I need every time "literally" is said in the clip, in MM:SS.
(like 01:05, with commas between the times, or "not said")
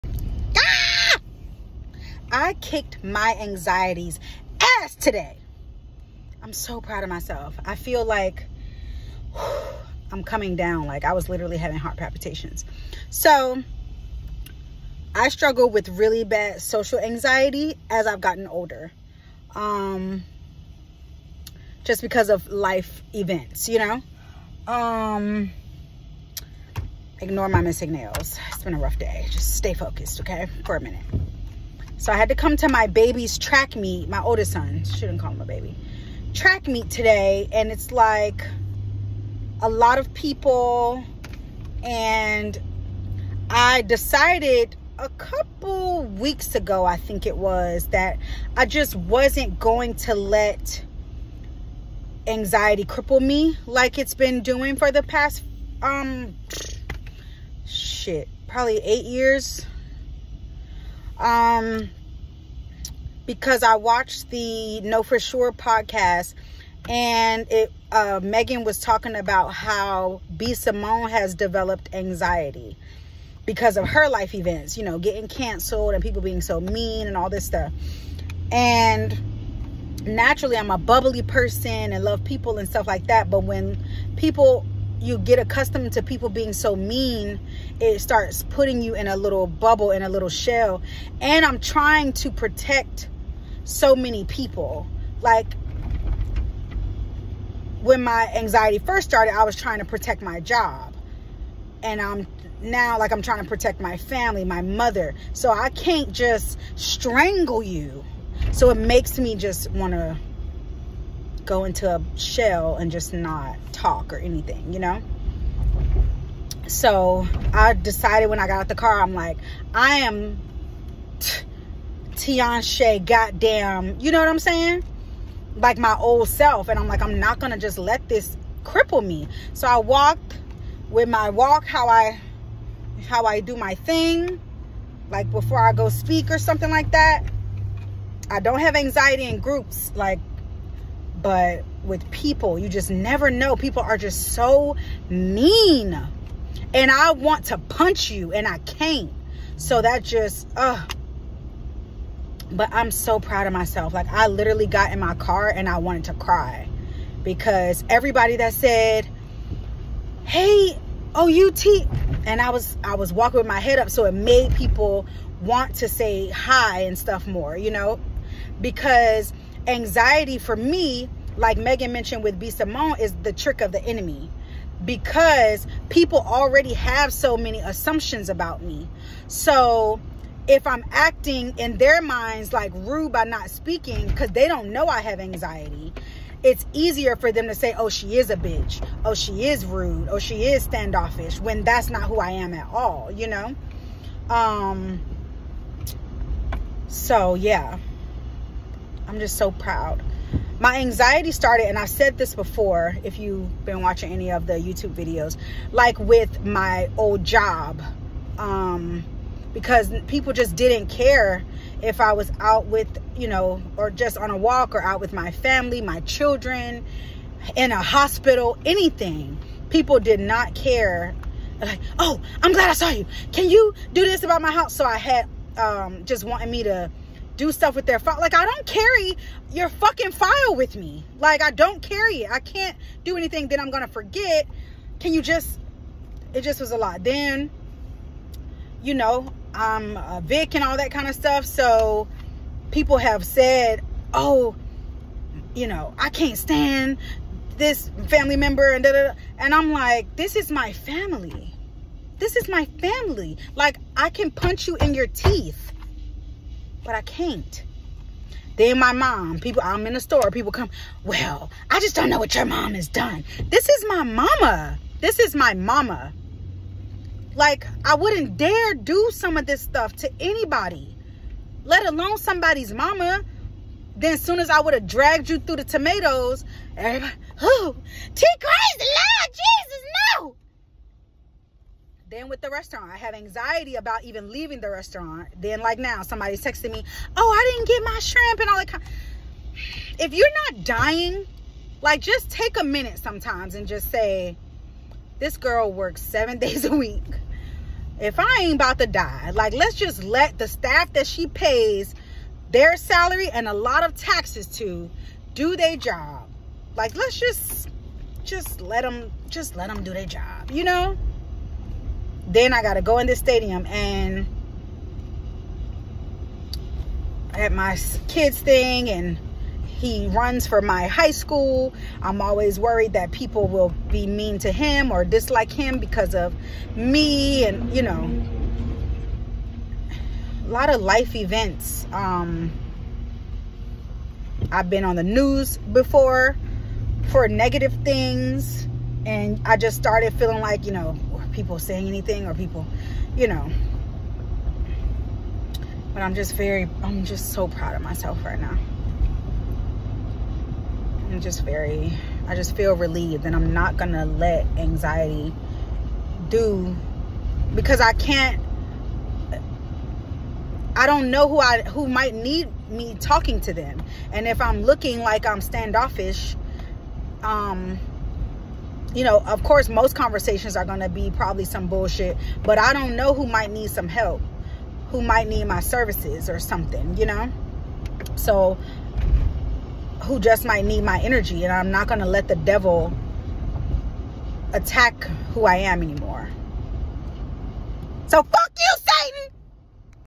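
00:11, 02:34.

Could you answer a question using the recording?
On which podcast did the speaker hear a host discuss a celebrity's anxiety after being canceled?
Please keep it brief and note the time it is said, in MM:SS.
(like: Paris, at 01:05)
Know For Sure, at 01:04.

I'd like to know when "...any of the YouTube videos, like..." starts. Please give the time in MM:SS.
03:24.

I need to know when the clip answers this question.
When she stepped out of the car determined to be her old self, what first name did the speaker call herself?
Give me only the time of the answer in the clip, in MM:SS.
02:02.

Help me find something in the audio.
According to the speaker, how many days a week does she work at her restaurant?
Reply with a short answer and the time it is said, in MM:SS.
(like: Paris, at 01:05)
7, at 04:56.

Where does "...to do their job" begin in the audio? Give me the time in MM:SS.
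05:04.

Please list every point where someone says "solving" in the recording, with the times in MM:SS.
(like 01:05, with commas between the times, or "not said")
not said.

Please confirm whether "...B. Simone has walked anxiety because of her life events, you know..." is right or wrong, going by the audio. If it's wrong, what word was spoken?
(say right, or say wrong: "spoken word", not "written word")
wrong: "developed", not "walked".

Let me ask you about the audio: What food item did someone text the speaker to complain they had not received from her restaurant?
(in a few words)
Shrimp.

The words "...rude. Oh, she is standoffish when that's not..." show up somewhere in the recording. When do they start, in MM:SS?
03:09.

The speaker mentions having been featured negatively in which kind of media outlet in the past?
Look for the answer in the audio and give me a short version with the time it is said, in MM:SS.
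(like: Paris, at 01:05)
The news, at 05:34.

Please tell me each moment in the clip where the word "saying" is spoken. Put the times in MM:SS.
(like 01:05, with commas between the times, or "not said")
02:04, 05:41.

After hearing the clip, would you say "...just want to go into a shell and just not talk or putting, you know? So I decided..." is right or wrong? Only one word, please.
wrong.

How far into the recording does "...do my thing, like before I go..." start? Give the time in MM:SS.
02:13.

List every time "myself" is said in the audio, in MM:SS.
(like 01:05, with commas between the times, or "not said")
00:07, 02:33, 05:47.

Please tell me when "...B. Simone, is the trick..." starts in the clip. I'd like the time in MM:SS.
02:52.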